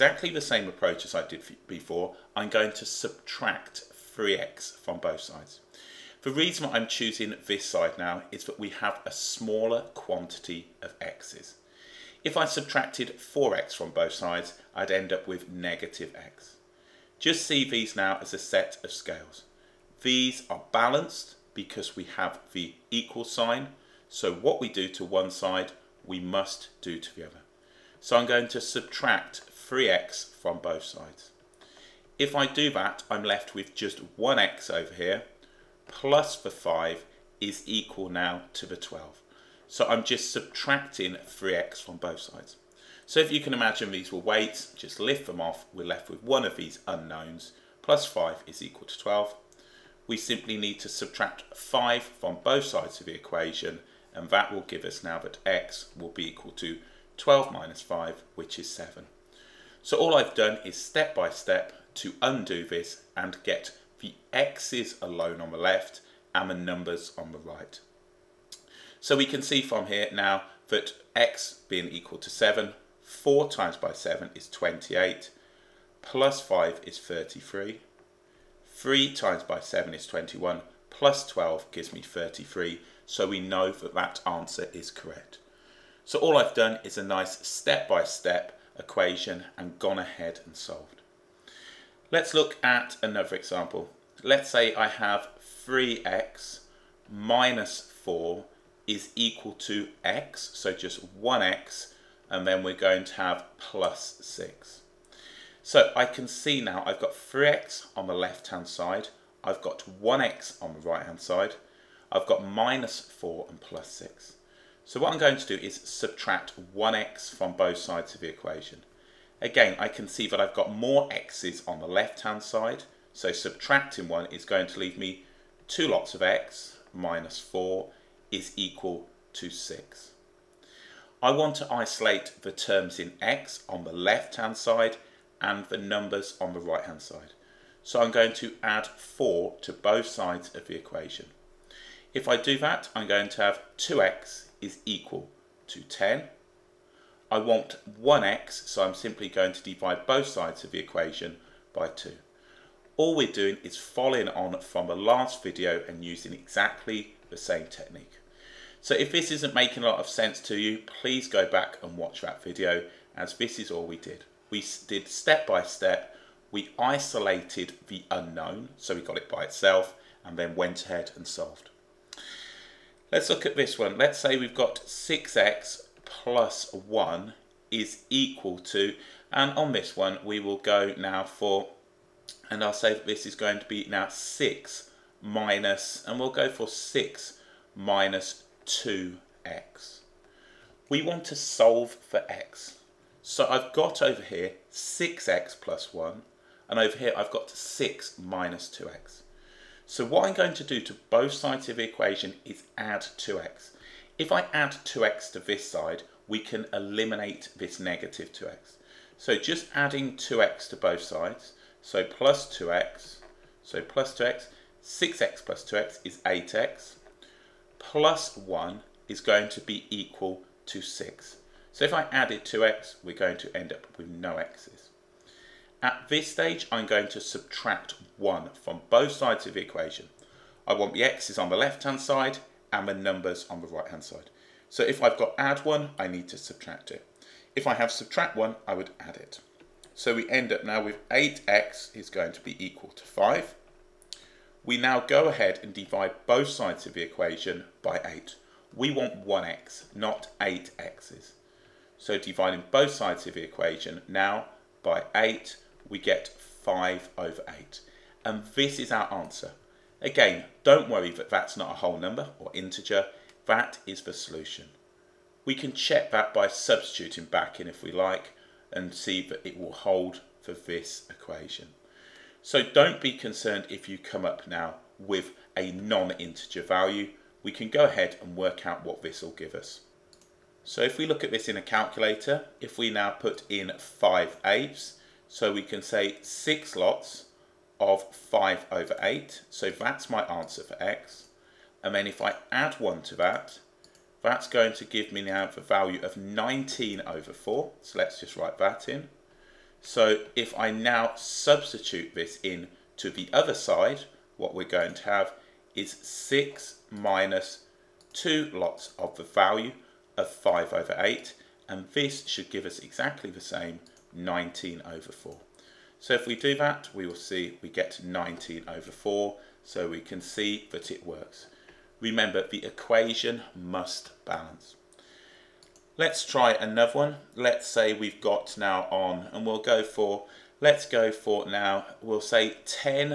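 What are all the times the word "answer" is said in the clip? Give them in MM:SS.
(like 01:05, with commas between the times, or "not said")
01:24, 04:19, 04:50.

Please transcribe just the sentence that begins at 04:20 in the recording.
Again, don't worry that that's not a whole number or integer.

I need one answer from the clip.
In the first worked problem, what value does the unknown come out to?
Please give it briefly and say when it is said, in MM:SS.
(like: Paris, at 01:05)
7, at 00:58.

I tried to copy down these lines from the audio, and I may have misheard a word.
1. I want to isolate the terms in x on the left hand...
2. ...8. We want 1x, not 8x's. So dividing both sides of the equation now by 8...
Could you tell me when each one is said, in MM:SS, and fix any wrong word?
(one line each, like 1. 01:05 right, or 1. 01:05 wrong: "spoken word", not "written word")
1. 02:11 right
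2. 04:08 right.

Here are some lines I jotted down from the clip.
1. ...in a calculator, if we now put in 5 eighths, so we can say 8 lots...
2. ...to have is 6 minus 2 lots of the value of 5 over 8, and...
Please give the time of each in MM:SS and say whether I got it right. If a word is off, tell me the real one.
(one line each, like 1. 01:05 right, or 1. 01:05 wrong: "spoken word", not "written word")
1. 04:41 wrong: "6", not "8"
2. 05:04 right.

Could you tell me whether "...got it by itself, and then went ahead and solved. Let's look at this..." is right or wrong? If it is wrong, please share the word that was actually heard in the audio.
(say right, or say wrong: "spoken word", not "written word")
right.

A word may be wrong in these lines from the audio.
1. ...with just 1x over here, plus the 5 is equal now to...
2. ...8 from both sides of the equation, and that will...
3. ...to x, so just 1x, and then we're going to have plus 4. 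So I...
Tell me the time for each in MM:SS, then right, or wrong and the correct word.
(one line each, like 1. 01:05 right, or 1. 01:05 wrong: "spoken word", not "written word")
1. 00:33 right
2. 00:51 wrong: "5", not "8"
3. 01:39 wrong: "6", not "4".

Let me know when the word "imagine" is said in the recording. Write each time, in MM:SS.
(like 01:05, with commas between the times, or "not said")
00:43.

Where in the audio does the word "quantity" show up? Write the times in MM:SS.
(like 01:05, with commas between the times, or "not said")
00:09.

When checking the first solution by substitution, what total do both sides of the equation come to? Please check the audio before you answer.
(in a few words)
33.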